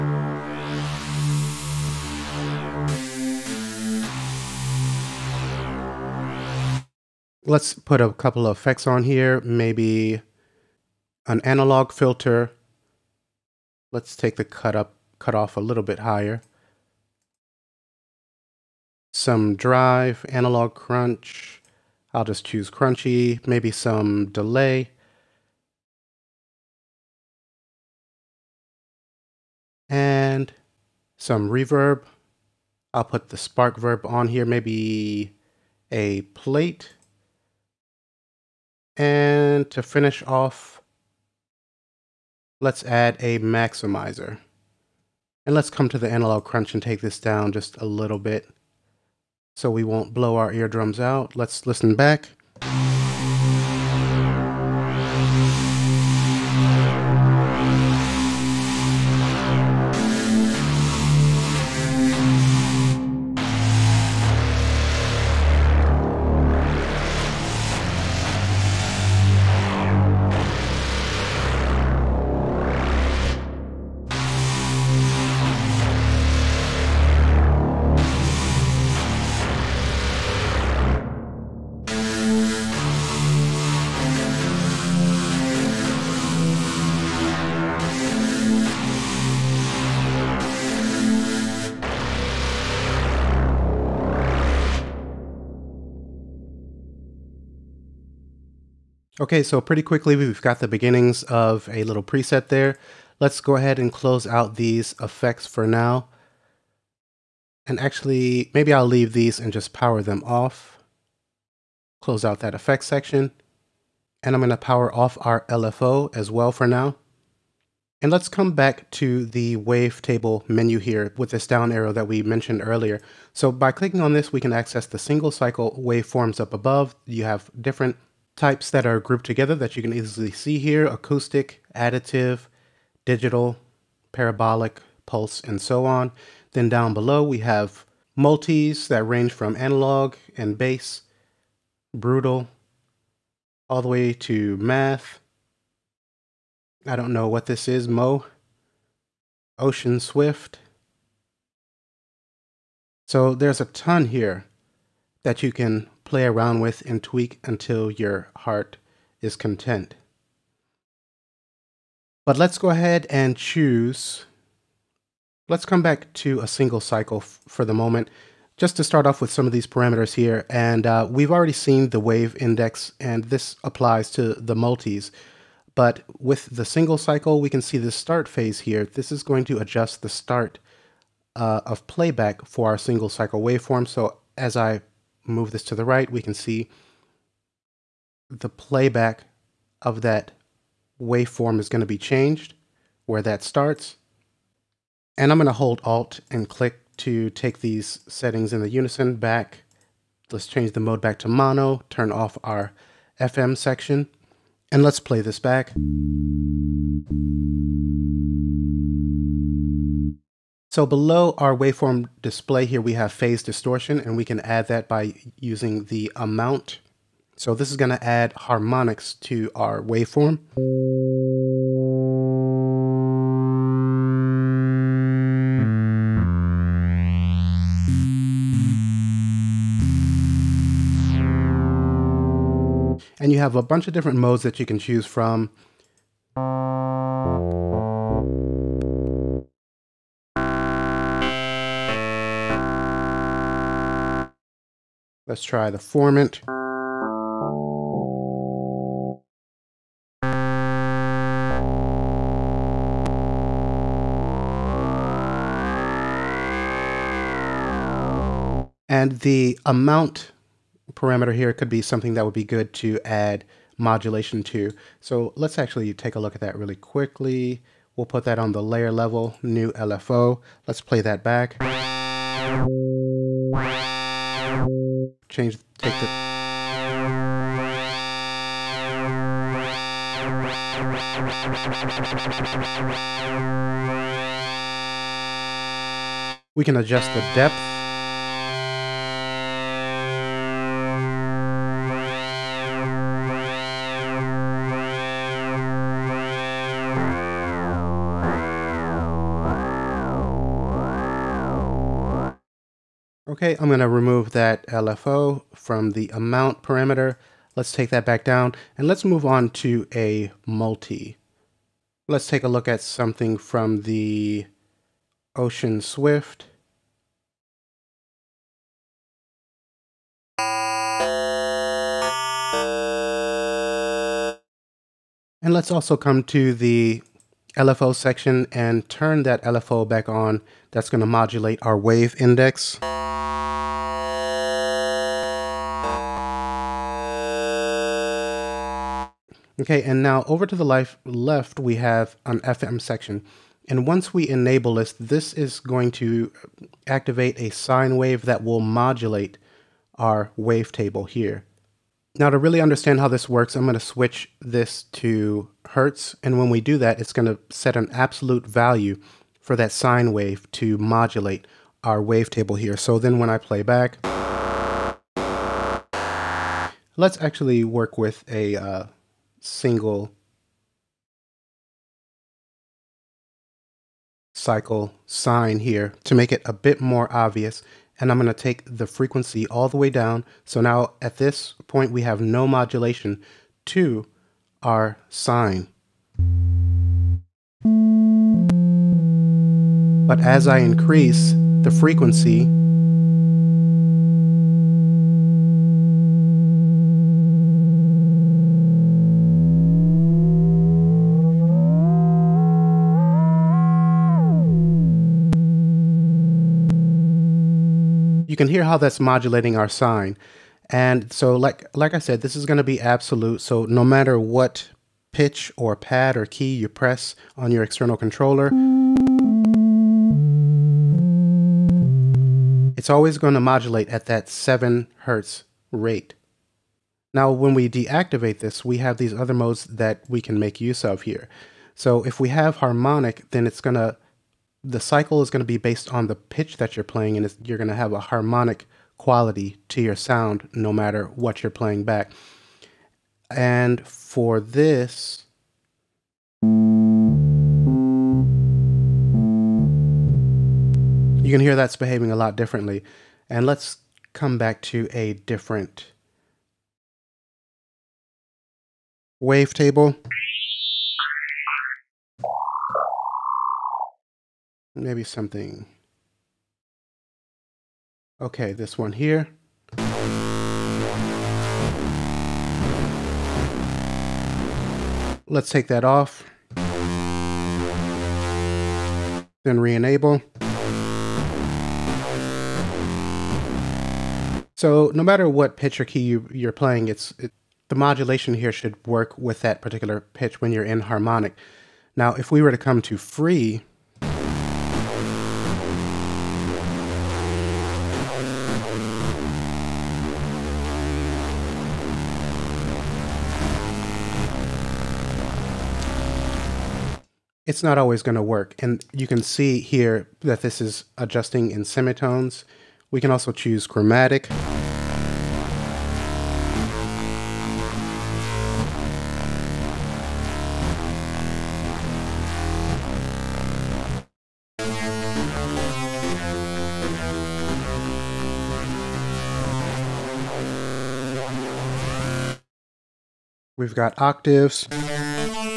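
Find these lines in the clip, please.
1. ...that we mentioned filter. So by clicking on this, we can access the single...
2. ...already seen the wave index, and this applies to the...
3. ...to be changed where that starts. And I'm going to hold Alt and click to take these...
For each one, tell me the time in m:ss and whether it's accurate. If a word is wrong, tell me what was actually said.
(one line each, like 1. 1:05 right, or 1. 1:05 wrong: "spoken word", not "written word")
1. 2:01 wrong: "earlier", not "filter"
2. 2:51 right
3. 3:11 right.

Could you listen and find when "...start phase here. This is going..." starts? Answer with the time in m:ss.
2:57.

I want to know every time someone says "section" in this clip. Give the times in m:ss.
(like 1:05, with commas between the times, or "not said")
1:52, 3:23, 5:27, 5:42.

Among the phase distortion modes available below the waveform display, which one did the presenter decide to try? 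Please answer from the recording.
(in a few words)
formant.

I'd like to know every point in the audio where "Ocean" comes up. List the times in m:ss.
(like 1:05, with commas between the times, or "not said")
2:29, 5:15.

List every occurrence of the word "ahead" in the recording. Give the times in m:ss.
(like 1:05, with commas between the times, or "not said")
1:43, 2:42.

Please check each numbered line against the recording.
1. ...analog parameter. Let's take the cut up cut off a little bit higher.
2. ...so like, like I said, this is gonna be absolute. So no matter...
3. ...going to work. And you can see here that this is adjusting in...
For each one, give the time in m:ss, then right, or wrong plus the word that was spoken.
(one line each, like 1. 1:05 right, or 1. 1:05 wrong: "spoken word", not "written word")
1. 0:11 wrong: "filter", not "parameter"
2. 6:51 right
3. 8:28 right.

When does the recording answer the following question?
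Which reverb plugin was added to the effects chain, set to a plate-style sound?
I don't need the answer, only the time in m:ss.
0:33.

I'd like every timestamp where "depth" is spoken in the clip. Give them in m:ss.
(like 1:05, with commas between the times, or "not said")
4:47.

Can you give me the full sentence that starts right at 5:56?
And when we do that, it's going to set an absolute value for that sine wave to modulate our wavetable here.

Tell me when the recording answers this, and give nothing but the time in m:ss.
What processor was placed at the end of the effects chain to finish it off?
0:43.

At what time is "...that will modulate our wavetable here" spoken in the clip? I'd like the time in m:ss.
5:48.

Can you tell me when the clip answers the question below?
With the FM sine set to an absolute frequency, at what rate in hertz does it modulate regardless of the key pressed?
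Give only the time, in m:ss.
7:04.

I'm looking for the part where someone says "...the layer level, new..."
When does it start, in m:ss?
4:28.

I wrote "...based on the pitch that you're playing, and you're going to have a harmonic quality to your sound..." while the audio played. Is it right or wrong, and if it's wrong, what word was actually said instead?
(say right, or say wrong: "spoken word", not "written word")
right.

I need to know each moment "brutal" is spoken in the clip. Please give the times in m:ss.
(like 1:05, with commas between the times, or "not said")
2:21.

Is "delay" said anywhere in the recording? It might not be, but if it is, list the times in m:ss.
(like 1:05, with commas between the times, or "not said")
0:24.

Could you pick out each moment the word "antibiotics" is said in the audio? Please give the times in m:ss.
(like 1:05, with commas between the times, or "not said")
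not said.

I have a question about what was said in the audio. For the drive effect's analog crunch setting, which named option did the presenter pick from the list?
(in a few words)
crunchy.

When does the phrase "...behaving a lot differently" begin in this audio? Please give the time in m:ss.
7:31.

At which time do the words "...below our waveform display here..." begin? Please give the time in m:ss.
3:30.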